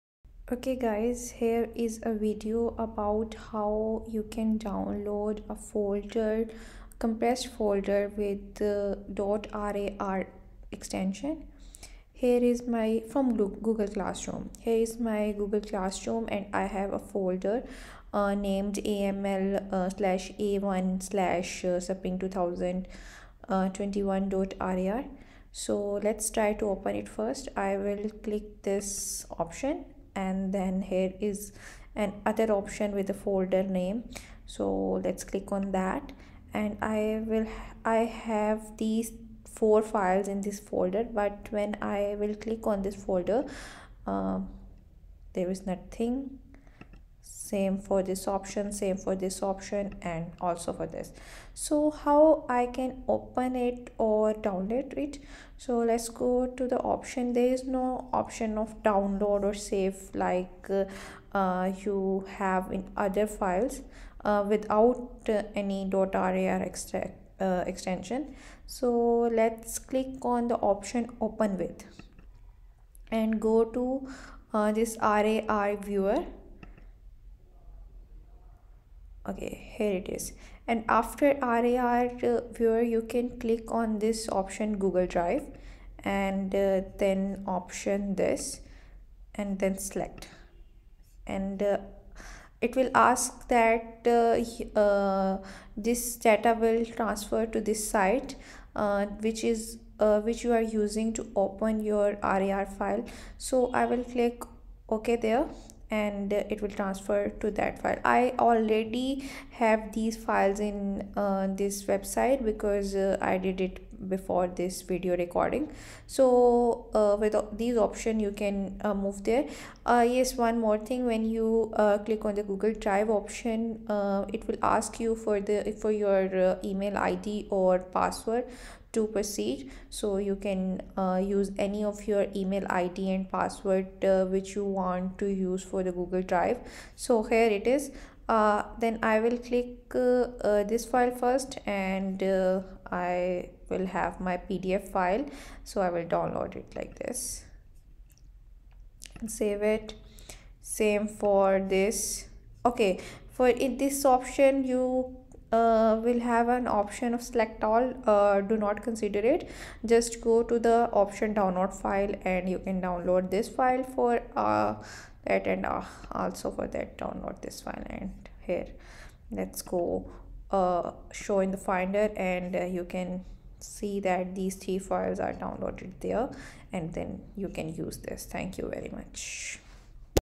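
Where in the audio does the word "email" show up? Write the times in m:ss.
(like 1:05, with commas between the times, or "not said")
2:06, 2:12.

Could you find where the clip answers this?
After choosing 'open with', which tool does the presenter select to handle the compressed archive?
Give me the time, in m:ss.
1:15.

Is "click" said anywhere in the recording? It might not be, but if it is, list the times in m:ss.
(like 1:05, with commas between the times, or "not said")
0:28, 0:35, 0:42, 1:09, 1:23, 1:44, 2:01, 2:19.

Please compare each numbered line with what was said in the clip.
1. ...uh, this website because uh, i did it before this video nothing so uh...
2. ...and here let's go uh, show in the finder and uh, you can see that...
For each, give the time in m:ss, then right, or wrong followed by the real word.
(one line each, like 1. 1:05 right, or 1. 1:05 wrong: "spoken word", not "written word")
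1. 1:51 wrong: "recording", not "nothing"
2. 2:47 right.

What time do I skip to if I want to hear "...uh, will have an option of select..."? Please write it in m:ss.
2:35.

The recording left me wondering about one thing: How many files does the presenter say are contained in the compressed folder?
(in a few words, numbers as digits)
4.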